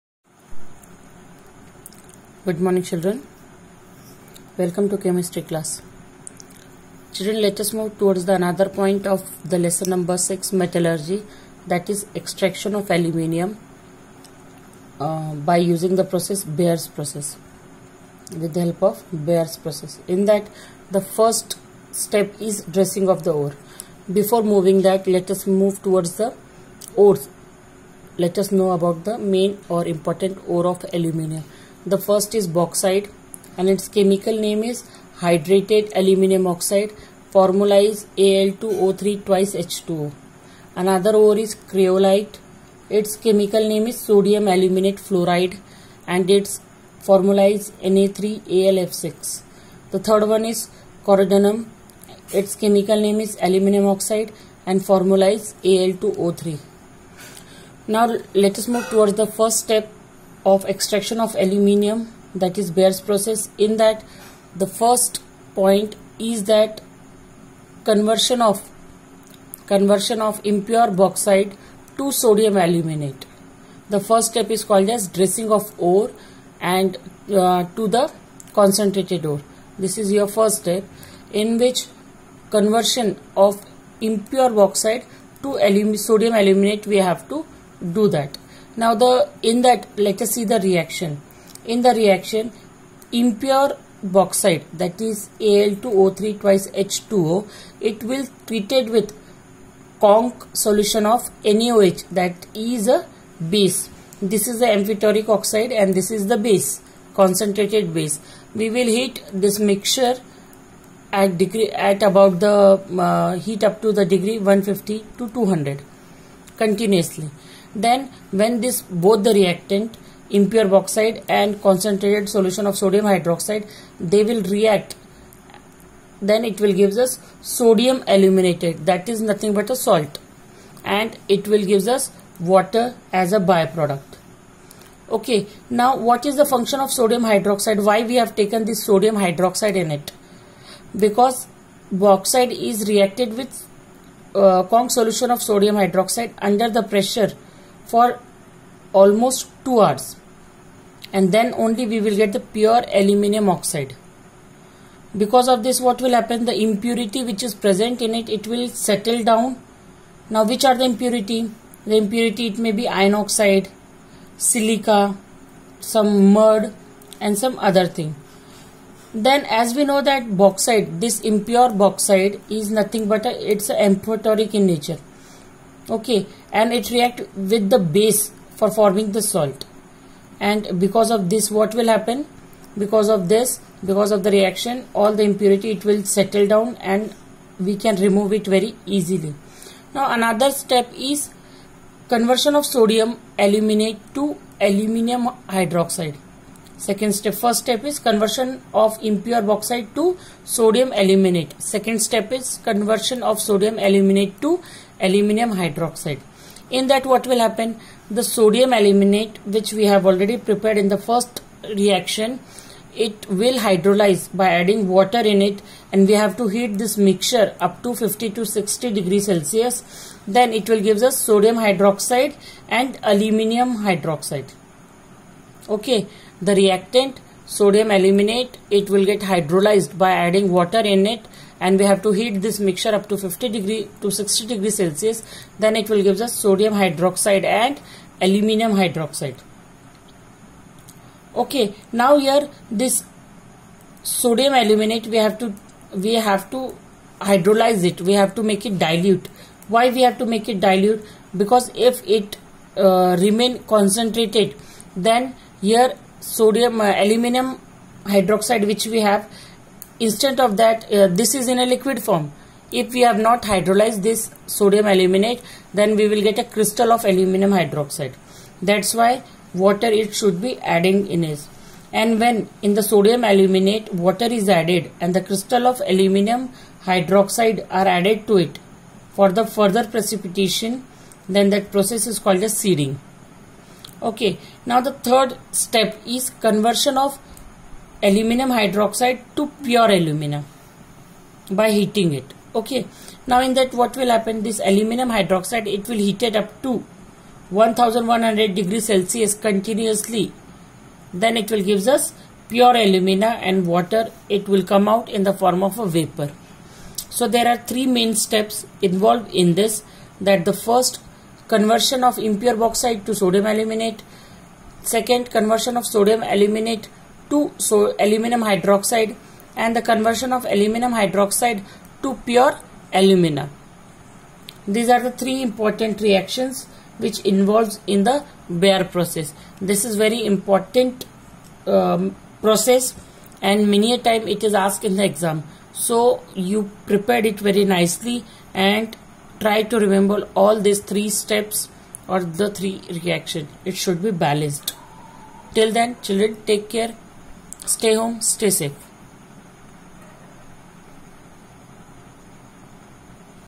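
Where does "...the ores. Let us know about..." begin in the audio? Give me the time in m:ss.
0:26.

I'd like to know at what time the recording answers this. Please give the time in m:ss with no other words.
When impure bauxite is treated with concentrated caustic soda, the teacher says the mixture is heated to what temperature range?
1:54.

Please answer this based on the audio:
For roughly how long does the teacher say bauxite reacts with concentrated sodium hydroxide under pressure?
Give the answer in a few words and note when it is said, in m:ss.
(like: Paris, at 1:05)
2 hours, at 2:29.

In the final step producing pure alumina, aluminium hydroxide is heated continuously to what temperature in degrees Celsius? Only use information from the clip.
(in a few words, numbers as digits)
1100.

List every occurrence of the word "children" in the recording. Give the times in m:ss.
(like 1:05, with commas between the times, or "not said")
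0:02, 0:07, 5:46.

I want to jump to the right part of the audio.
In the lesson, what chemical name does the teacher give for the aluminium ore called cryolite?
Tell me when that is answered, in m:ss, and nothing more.
0:43.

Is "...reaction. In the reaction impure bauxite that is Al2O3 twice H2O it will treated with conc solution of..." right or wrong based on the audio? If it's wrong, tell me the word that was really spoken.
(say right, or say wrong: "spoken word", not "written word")
right.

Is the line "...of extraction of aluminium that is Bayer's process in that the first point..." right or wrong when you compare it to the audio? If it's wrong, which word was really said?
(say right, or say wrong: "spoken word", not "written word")
right.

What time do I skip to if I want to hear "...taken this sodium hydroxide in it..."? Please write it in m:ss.
2:18.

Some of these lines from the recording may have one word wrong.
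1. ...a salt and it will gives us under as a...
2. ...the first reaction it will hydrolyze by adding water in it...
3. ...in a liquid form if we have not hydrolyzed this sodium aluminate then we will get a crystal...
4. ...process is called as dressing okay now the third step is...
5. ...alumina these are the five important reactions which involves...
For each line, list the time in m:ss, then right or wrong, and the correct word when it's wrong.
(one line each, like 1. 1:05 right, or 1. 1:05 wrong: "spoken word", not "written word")
1. 2:09 wrong: "water", not "under"
2. 3:30 right
3. 4:21 right
4. 4:41 wrong: "seeding", not "dressing"
5. 5:23 wrong: "three", not "five".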